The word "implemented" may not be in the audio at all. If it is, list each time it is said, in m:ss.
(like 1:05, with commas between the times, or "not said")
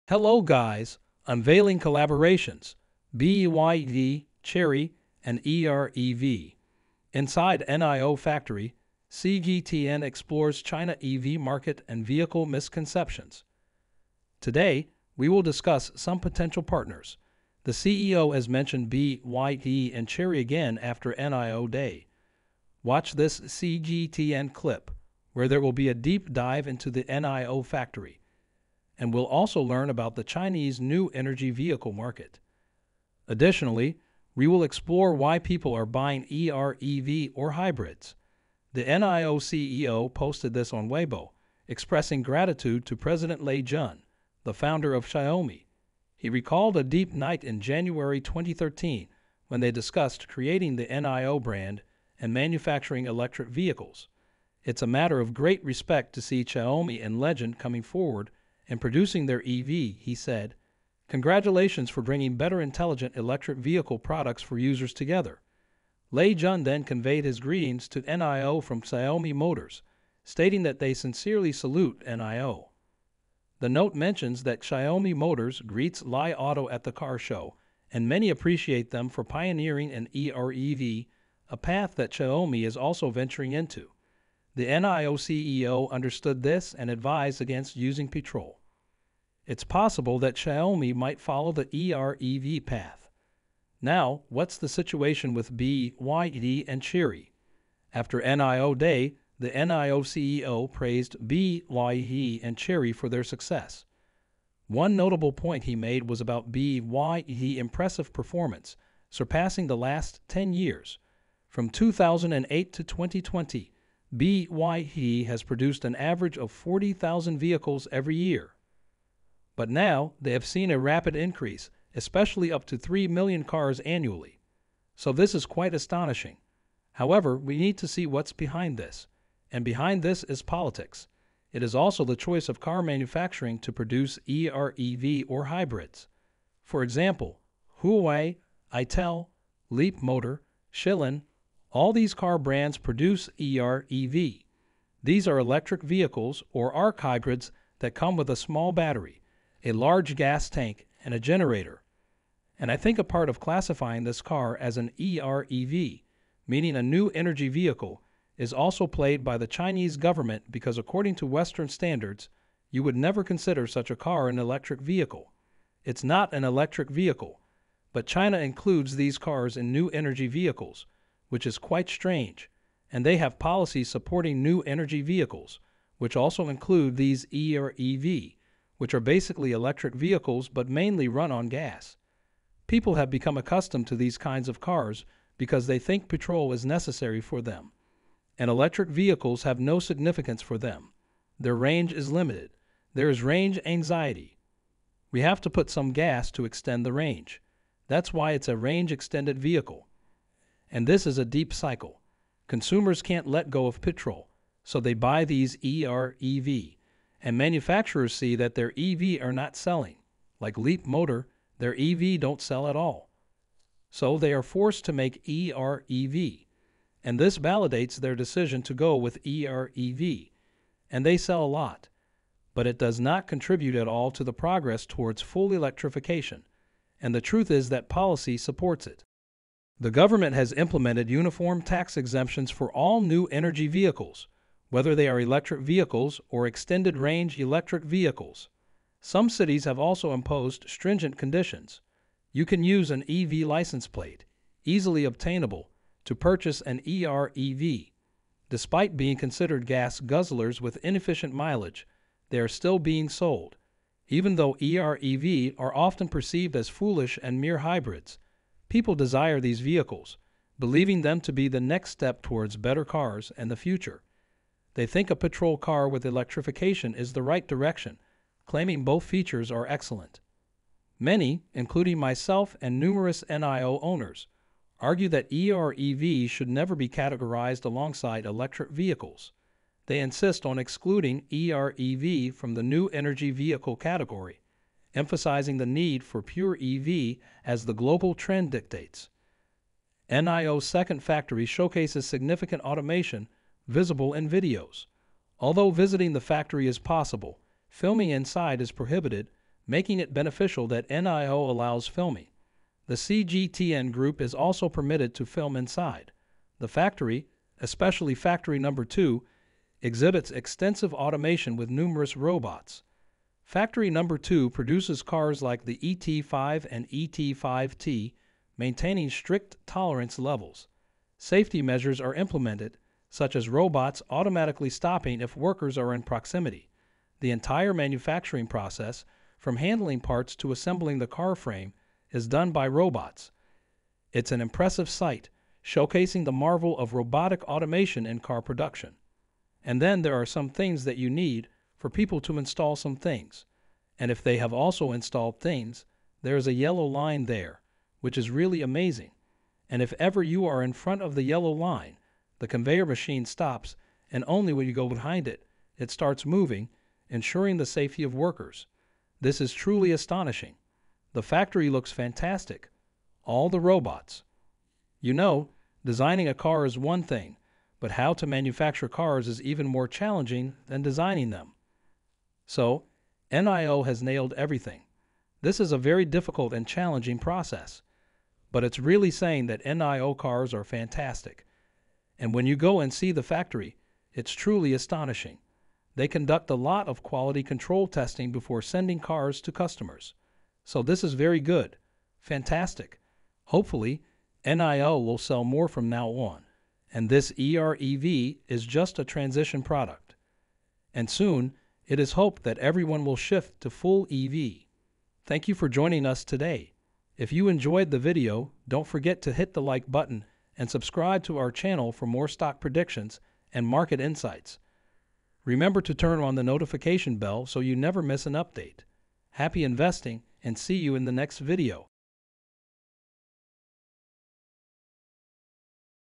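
3:50, 5:22.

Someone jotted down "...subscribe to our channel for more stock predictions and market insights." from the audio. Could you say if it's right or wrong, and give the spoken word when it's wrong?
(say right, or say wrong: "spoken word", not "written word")
right.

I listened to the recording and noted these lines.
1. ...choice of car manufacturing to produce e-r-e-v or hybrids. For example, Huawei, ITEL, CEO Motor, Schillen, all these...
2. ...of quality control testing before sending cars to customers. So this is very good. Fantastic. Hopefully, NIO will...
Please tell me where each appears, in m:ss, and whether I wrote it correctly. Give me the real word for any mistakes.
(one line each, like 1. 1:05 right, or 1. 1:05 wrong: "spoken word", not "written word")
1. 2:12 wrong: "Leap", not "CEO"
2. 6:26 right.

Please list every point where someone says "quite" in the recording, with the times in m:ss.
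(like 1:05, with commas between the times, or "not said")
2:05, 2:51.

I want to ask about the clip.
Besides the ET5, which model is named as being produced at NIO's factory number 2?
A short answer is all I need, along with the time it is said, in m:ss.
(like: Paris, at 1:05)
ET5T, at 5:16.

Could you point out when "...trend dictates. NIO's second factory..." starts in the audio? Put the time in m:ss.
4:48.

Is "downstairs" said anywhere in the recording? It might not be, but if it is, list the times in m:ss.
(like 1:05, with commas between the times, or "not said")
not said.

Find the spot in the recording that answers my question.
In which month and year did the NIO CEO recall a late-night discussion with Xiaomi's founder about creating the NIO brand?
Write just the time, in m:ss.
0:47.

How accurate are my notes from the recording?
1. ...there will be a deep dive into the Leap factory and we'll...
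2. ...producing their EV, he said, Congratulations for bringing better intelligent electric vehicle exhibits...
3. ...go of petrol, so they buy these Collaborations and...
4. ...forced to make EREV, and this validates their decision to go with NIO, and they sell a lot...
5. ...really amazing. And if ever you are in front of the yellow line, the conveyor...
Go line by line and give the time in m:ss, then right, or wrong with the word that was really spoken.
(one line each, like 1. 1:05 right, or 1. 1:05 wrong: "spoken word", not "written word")
1. 0:25 wrong: "NIO", not "Leap"
2. 0:58 wrong: "products", not "exhibits"
3. 3:23 wrong: "EREV", not "Collaborations"
4. 3:34 wrong: "EREV", not "NIO"
5. 5:48 right.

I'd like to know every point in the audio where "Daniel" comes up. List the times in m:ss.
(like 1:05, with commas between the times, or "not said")
not said.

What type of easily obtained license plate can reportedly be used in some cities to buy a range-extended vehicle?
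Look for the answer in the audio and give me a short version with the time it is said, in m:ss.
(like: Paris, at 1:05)
EV license plate, at 4:03.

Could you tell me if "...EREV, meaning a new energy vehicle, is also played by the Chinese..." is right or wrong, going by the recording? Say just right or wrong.
right.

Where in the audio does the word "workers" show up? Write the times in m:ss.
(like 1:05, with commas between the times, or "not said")
5:25, 5:58.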